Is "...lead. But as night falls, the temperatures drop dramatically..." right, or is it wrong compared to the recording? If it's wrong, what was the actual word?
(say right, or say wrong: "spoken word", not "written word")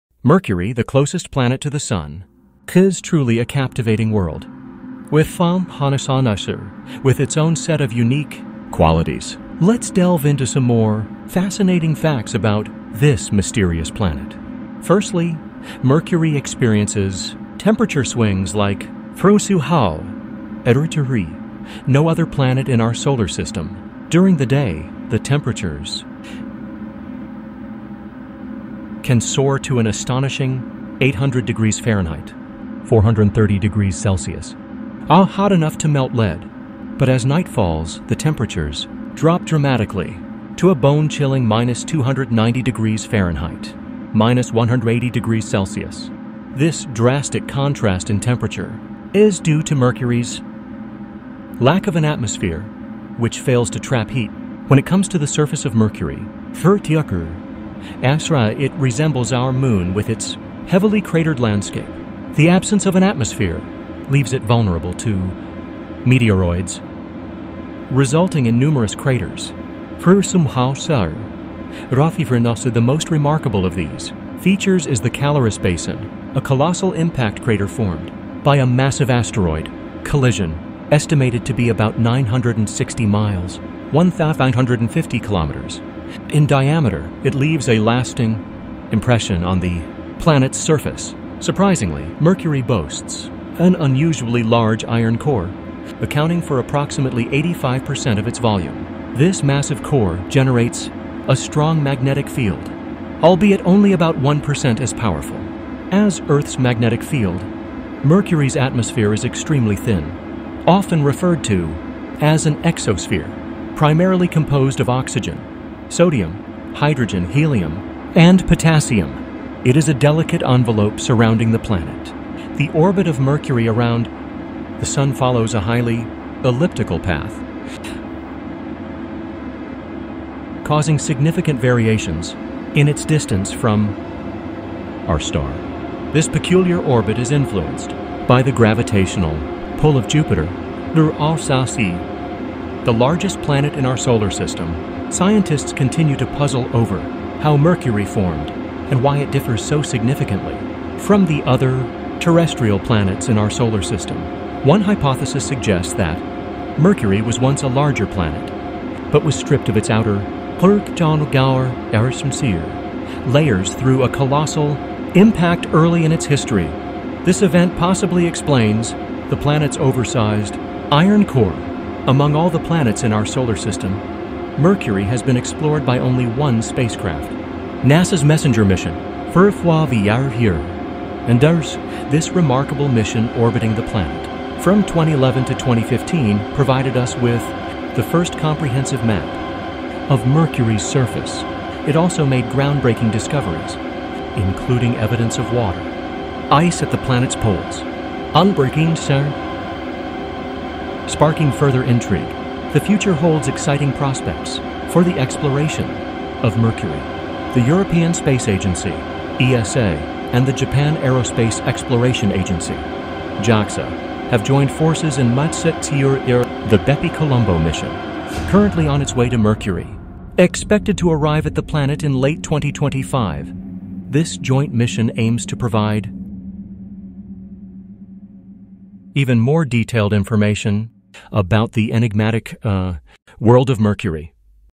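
right.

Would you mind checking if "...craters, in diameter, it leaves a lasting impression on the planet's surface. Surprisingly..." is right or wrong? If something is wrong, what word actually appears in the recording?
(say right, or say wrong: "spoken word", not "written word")
wrong: "kilometers", not "craters".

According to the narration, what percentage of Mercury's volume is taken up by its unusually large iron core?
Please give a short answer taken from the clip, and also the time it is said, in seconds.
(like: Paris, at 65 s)
85%, at 97 s.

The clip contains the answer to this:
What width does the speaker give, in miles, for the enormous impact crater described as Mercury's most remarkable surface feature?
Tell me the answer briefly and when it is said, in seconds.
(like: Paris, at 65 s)
960 miles, at 81 s.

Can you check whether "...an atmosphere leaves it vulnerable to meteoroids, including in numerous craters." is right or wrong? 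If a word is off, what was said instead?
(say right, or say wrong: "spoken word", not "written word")
wrong: "resulting", not "including".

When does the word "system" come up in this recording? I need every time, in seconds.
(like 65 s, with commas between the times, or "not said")
23 s, 144 s, 153 s, 173 s.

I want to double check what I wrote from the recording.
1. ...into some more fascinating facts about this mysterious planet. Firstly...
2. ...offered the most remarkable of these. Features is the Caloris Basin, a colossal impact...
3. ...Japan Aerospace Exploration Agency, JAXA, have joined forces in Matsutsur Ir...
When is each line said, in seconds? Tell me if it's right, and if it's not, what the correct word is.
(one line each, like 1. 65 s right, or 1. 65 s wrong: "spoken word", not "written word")
1. 10 s right
2. 72 s right
3. 210 s right.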